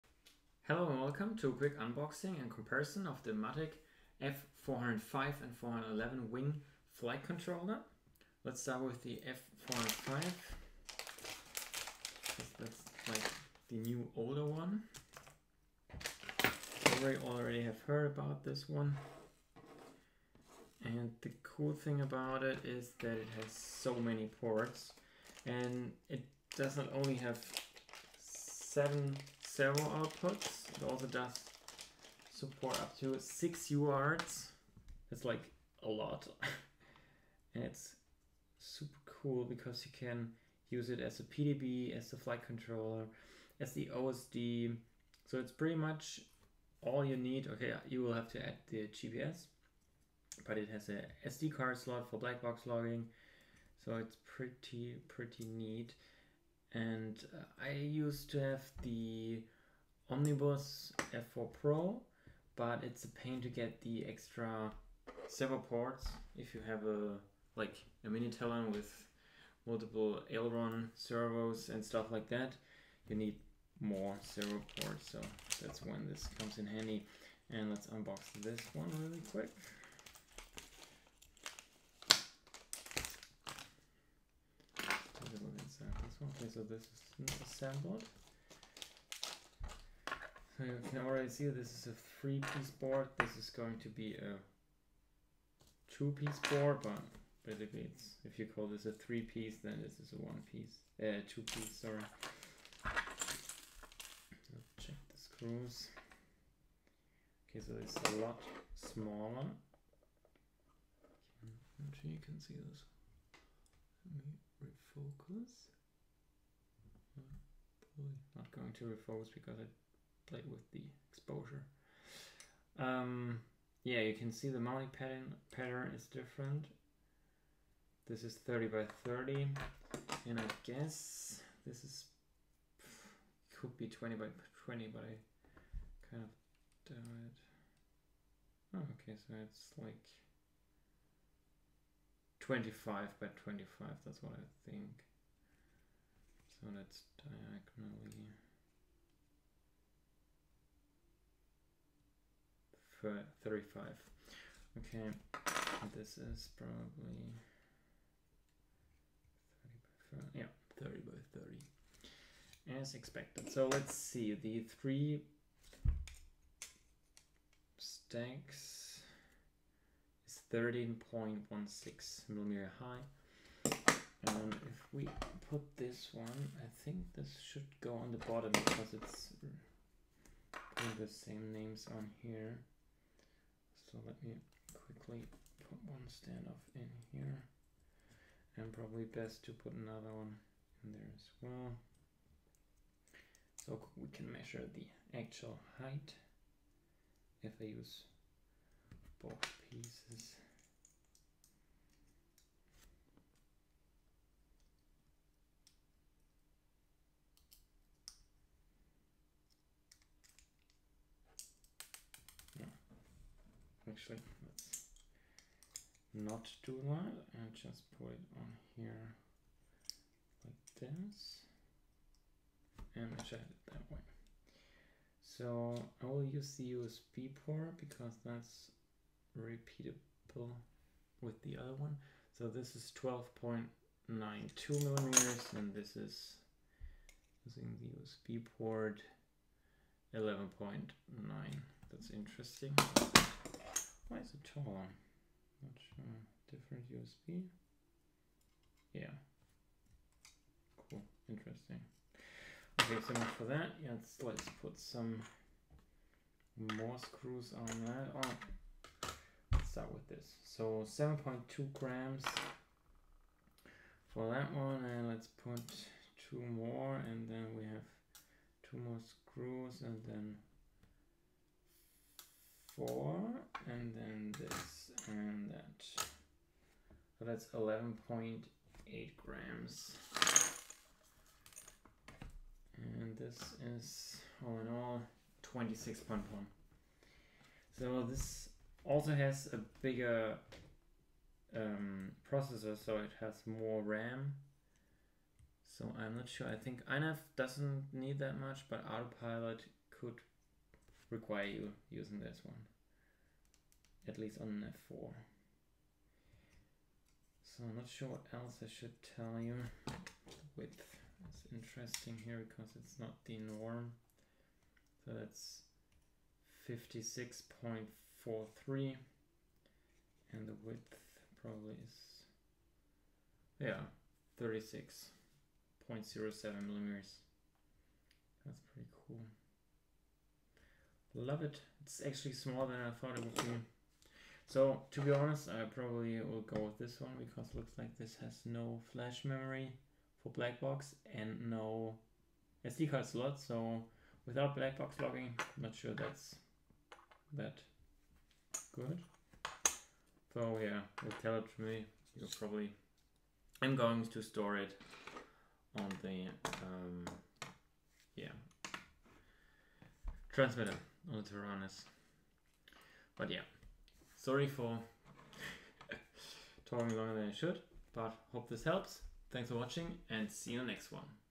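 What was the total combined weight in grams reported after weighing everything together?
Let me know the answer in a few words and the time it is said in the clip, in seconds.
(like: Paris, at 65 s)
26.1 grams, at 285 s.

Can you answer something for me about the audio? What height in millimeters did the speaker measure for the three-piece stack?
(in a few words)
13.16 mm.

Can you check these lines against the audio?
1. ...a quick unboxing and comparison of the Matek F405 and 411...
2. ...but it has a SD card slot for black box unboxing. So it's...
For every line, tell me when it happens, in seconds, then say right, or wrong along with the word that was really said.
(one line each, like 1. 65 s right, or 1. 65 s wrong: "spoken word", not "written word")
1. 1 s right
2. 50 s wrong: "logging", not "unboxing".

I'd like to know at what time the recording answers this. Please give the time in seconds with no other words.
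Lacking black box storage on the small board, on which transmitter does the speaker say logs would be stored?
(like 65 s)
361 s.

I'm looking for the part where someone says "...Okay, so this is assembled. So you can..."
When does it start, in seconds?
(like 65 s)
86 s.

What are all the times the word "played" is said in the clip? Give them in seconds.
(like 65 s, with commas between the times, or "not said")
120 s.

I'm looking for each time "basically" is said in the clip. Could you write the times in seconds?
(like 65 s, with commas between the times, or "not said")
97 s.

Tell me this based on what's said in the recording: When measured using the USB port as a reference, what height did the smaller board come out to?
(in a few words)
11.9 mm.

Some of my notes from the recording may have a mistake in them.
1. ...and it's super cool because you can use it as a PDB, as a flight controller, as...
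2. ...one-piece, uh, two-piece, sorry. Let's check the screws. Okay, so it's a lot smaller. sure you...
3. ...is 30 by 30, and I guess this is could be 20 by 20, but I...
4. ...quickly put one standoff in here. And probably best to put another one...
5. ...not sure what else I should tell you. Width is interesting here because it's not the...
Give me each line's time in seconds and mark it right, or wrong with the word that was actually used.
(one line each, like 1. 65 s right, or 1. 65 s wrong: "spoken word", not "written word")
1. 37 s right
2. 100 s right
3. 128 s right
4. 184 s right
5. 307 s right.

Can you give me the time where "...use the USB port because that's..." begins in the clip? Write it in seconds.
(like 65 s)
226 s.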